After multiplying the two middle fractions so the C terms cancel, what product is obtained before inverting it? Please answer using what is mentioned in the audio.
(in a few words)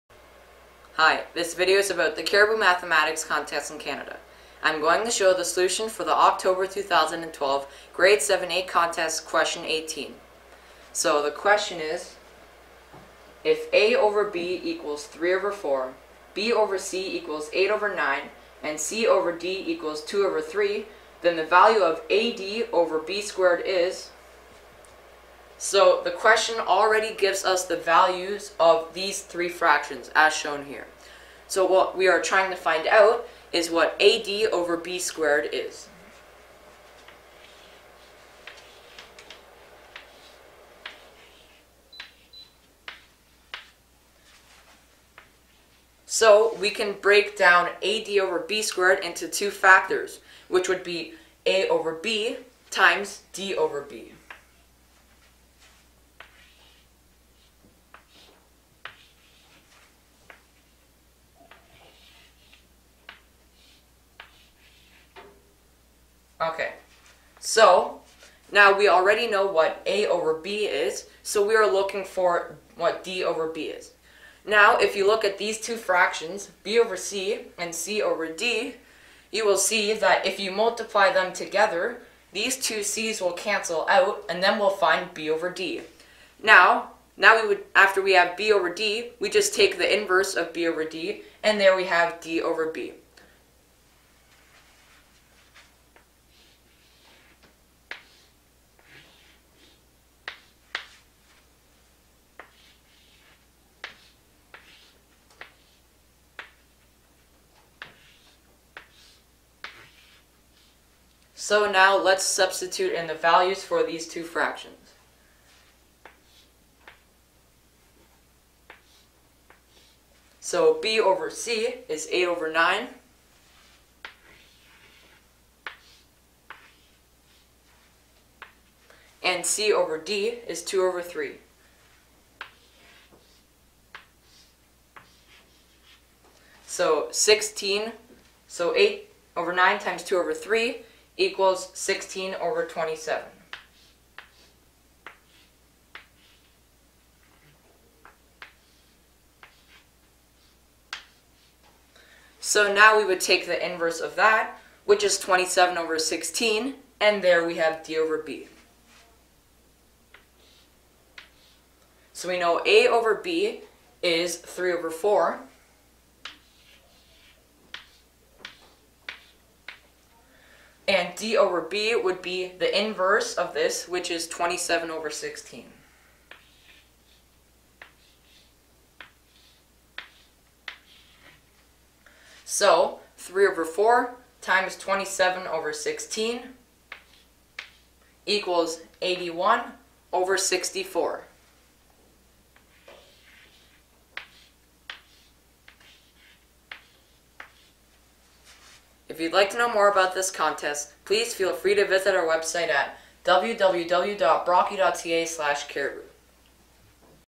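16/27.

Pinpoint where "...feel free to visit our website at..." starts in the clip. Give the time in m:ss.
3:21.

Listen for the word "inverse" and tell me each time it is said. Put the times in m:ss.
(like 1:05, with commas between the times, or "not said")
1:30, 2:33, 2:52.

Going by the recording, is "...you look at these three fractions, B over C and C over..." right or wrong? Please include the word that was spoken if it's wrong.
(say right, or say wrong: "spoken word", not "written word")
wrong: "two", not "three".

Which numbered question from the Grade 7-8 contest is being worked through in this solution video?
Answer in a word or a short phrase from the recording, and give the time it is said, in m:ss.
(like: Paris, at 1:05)
18, at 0:09.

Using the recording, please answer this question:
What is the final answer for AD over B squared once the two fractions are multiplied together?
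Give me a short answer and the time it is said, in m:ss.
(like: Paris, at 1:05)
81/64, at 3:09.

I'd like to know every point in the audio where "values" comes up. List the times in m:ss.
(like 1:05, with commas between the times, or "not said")
0:21, 0:27, 1:53.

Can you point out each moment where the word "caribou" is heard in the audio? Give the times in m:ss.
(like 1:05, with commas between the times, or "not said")
0:02, 3:25.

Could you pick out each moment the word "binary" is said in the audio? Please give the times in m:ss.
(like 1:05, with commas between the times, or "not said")
not said.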